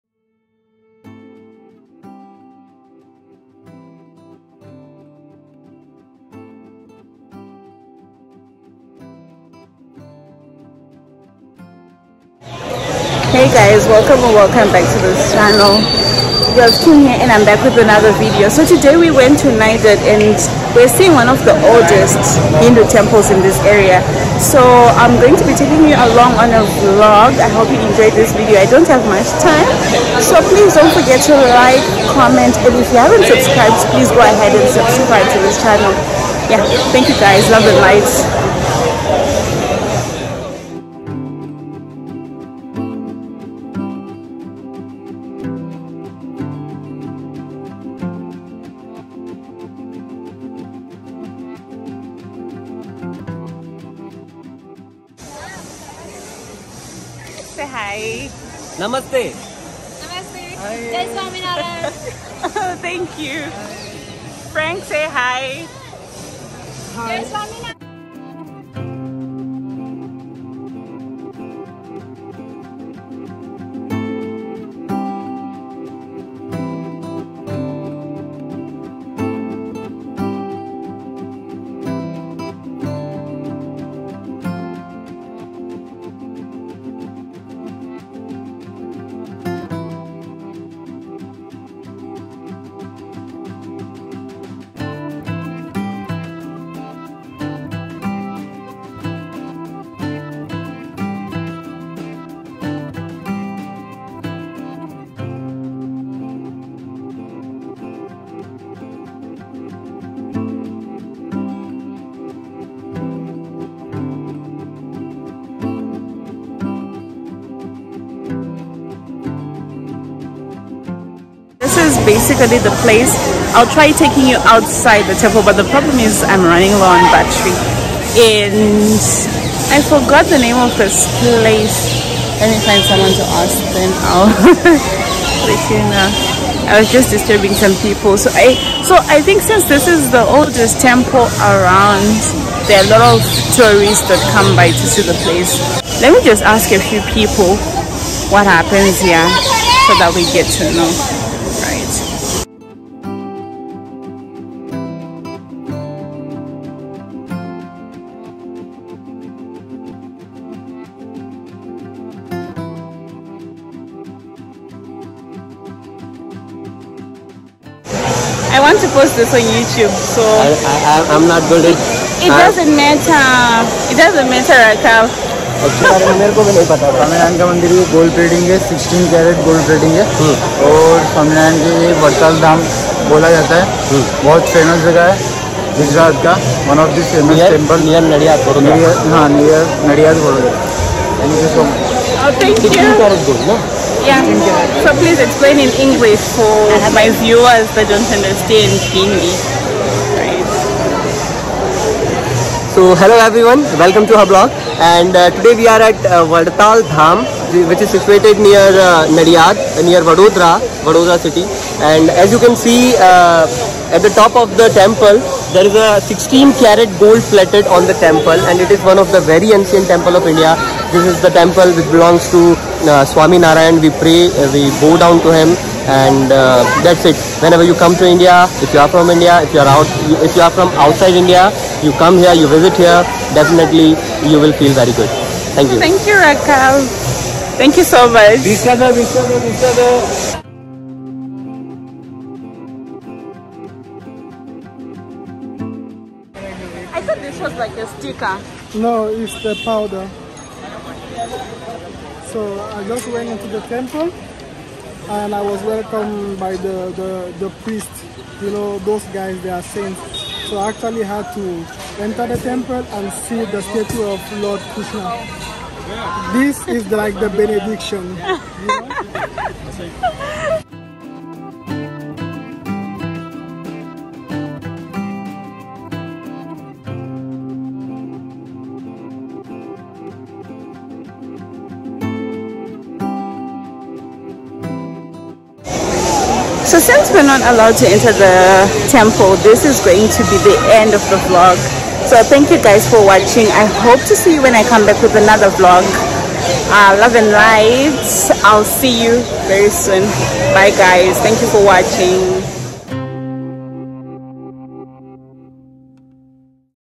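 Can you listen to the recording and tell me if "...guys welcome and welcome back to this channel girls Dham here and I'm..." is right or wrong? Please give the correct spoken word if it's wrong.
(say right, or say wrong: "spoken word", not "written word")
wrong: "Kim", not "Dham".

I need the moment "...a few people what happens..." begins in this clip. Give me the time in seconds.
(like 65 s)
146 s.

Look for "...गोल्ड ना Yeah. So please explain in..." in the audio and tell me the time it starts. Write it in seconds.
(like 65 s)
193 s.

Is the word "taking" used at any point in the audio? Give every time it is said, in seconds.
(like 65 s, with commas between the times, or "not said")
25 s, 123 s.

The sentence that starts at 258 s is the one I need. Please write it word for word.
You know, those guys, they are saints.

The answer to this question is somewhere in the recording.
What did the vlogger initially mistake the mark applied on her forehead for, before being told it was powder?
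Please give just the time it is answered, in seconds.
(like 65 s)
247 s.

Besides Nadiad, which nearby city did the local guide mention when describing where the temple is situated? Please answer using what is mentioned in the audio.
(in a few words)
Vadodara.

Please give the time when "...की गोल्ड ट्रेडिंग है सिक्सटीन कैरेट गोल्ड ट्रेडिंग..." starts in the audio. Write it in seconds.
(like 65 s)
177 s.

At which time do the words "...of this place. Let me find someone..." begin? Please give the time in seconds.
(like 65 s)
130 s.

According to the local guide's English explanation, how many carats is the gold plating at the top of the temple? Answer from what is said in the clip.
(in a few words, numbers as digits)
16.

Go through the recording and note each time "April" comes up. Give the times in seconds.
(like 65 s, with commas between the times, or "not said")
not said.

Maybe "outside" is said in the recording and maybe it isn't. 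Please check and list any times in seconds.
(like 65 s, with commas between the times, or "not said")
124 s, 230 s.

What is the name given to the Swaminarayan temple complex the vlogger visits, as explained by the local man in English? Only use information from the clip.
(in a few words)
Vadtal Dham.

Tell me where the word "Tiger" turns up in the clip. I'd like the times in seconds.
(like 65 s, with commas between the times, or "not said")
not said.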